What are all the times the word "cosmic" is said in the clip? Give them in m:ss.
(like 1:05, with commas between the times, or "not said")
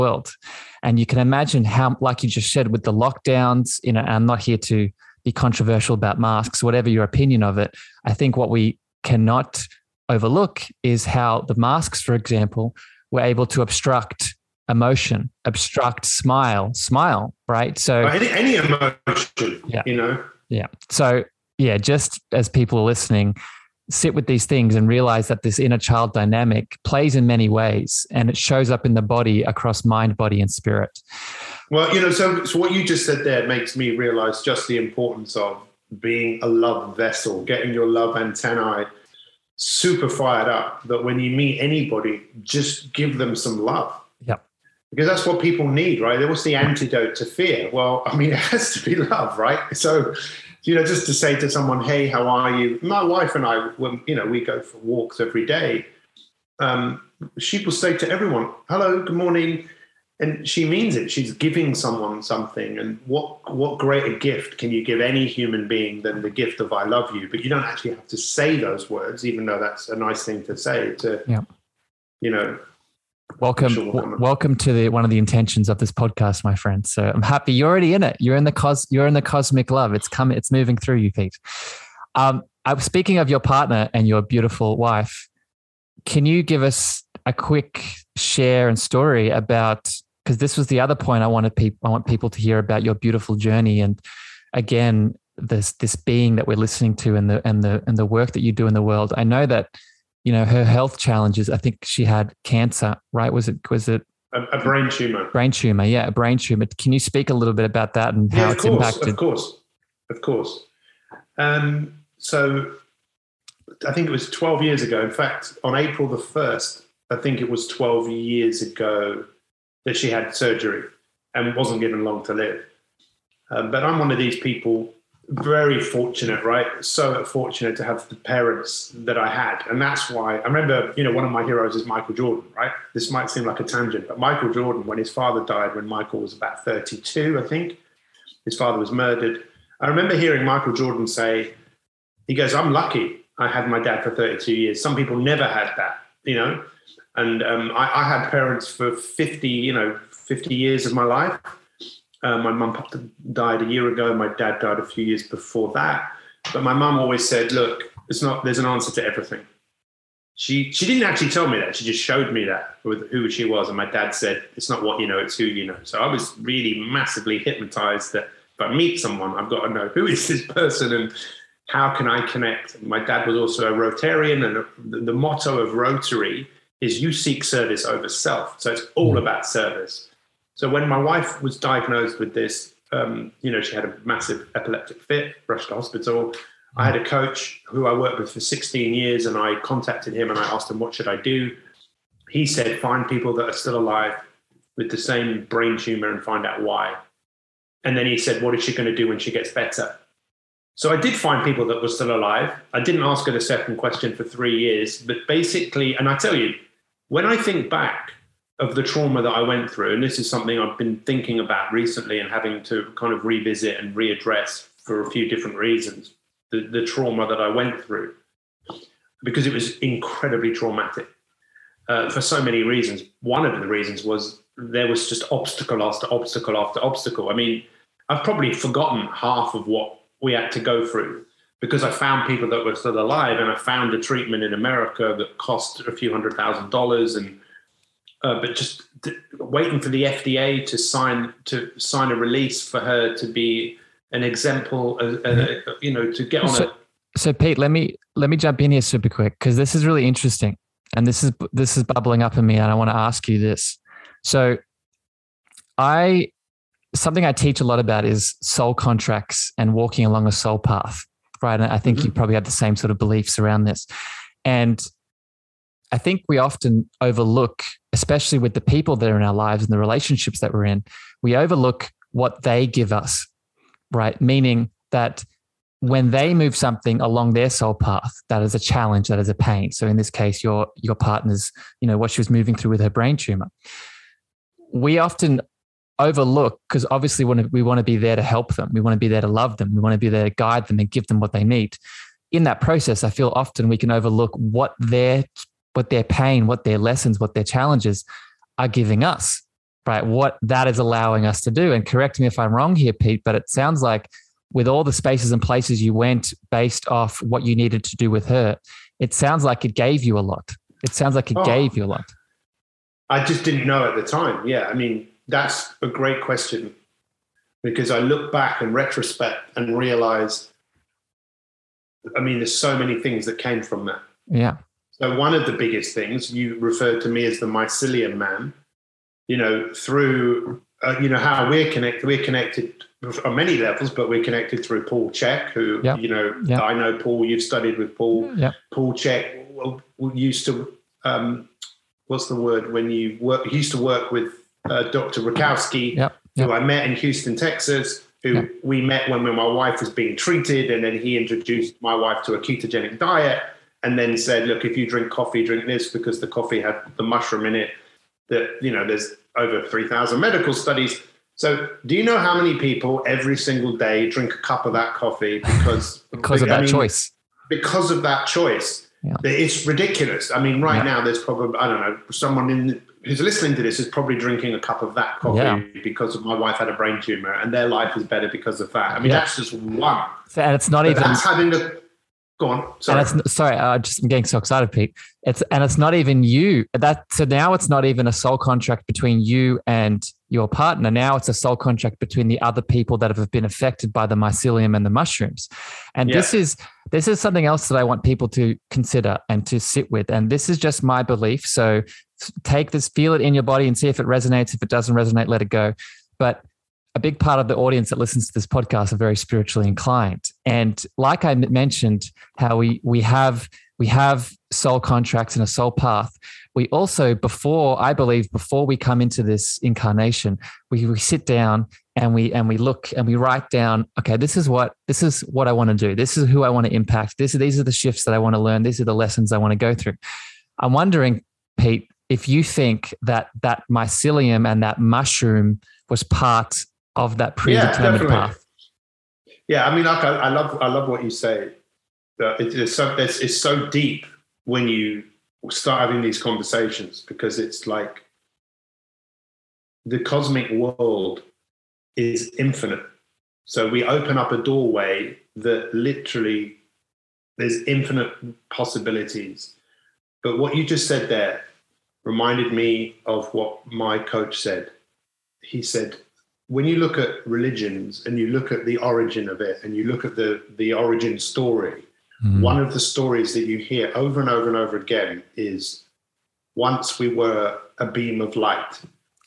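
1:19, 7:29.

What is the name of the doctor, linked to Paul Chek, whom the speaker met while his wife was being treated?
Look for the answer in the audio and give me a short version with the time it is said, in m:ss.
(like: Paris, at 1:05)
Dr. Rakowski, at 5:44.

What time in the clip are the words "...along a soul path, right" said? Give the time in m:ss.
4:20.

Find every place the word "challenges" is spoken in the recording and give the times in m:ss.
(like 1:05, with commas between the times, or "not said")
1:40, 4:38, 4:57.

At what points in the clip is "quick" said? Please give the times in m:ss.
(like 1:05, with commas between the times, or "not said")
1:27, 4:09.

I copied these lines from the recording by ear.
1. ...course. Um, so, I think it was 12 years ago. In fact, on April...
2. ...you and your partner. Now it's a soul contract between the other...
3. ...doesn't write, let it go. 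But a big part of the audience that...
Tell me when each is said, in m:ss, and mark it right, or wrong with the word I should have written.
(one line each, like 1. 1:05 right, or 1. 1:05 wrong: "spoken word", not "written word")
1. 1:50 right
2. 6:29 right
3. 6:44 wrong: "resonate", not "write".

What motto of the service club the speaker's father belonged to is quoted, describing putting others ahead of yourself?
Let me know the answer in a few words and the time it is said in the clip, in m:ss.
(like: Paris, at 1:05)
Service over self, at 2:57.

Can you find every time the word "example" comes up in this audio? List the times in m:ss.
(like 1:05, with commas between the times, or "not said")
0:12, 4:04.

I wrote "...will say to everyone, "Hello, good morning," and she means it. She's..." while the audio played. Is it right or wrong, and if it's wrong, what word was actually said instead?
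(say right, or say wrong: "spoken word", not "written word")
right.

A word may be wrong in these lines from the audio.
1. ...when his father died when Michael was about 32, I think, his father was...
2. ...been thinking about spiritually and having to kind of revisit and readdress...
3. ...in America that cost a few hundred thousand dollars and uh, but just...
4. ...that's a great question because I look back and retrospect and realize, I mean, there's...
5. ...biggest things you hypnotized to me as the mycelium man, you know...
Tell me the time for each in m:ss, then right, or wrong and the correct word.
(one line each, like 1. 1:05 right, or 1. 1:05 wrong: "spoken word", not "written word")
1. 2:14 right
2. 3:30 wrong: "recently", not "spiritually"
3. 3:54 right
4. 5:15 right
5. 5:25 wrong: "referred", not "hypnotized".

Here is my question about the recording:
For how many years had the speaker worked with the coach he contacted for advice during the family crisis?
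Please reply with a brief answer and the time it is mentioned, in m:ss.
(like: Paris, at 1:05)
16 years, at 3:08.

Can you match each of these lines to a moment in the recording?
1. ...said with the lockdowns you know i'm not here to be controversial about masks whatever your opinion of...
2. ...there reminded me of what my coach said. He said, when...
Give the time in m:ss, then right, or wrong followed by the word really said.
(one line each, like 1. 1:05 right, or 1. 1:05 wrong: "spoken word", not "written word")
1. 0:02 right
2. 7:41 right.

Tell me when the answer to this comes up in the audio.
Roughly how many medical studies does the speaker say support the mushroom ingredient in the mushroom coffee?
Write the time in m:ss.
5:59.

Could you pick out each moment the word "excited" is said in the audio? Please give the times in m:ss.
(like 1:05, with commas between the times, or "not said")
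6:24.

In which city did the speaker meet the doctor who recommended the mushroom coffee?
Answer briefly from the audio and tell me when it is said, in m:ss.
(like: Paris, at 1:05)
Houston, Texas, at 5:46.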